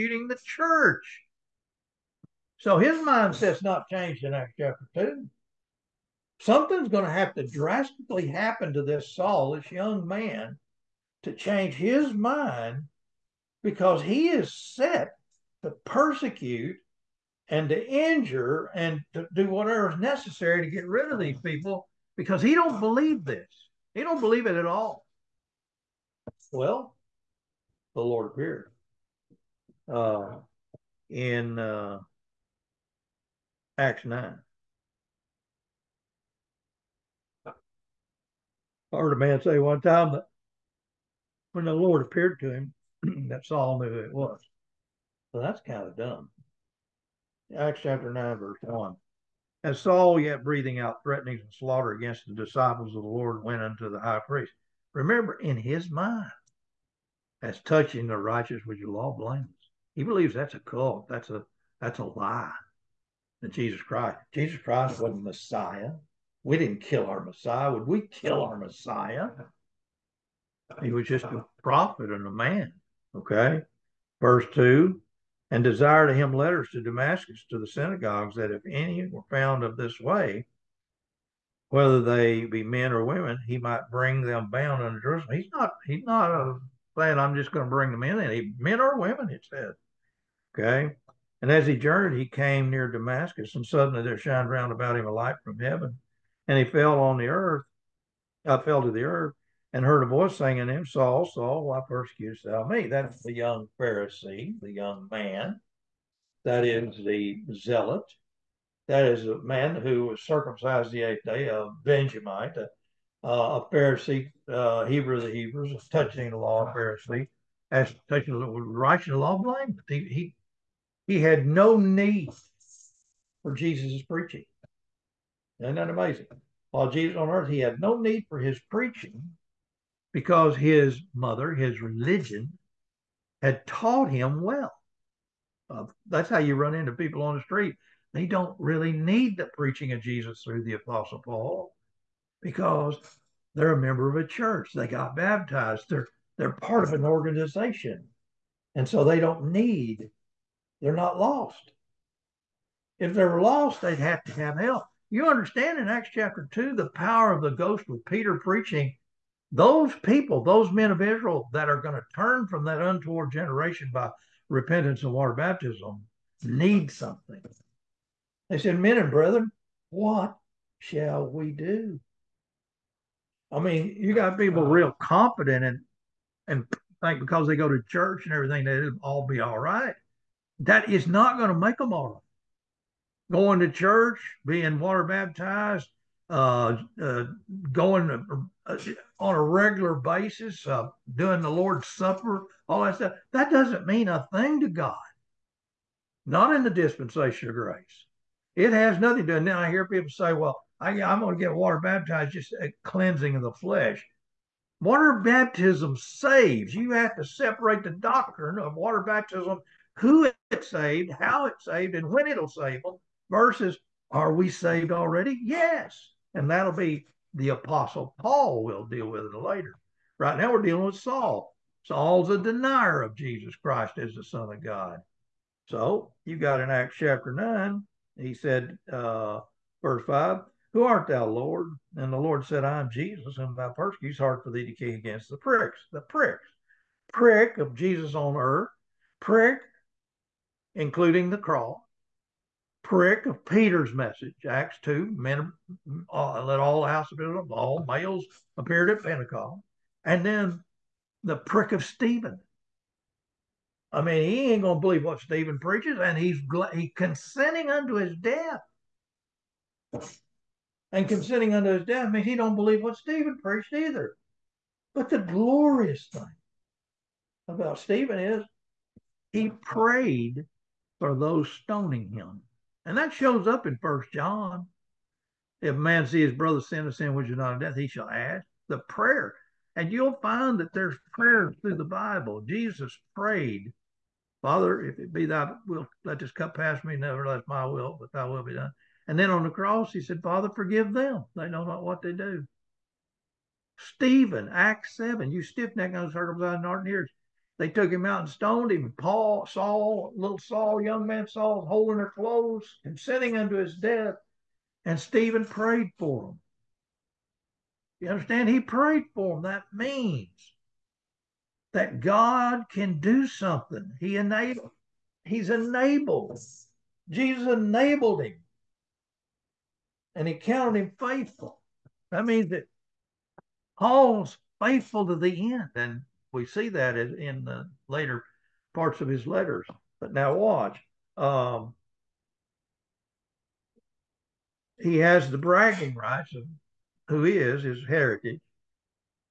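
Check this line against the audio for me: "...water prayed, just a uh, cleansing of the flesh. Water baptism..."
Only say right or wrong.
wrong.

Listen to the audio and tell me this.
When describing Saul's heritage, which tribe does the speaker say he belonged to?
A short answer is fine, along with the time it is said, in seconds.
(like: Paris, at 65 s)
Benjamite, at 111 s.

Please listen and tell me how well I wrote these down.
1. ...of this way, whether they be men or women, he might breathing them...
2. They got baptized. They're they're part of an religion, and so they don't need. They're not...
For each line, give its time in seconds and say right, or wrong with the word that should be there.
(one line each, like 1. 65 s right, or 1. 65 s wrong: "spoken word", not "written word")
1. 79 s wrong: "bring", not "breathing"
2. 144 s wrong: "organization", not "religion".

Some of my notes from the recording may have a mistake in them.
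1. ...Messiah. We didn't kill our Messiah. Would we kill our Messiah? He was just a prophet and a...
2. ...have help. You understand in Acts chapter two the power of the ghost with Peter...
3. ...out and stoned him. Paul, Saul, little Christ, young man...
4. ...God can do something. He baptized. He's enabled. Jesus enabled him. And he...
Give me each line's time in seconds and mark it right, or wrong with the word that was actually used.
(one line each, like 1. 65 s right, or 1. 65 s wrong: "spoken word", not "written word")
1. 65 s right
2. 154 s right
3. 298 s wrong: "Saul", not "Christ"
4. 311 s wrong: "enabled", not "baptized".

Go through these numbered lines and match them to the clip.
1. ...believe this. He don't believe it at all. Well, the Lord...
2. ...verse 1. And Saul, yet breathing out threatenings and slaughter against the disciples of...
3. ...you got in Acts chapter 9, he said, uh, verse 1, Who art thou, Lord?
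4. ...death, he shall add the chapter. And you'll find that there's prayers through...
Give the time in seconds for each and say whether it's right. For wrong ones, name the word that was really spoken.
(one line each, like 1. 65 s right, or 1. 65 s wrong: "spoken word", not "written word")
1. 22 s right
2. 48 s right
3. 226 s wrong: "5", not "1"
4. 277 s wrong: "prayer", not "chapter".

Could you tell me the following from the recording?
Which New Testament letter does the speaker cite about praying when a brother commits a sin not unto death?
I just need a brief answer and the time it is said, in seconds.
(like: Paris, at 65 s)
First John, at 273 s.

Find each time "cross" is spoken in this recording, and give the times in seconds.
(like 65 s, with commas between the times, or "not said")
241 s, 289 s.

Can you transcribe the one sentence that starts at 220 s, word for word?
Right now, we're dealing with Saul.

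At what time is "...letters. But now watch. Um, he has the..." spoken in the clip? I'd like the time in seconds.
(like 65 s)
329 s.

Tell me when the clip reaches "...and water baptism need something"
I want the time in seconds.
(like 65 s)
165 s.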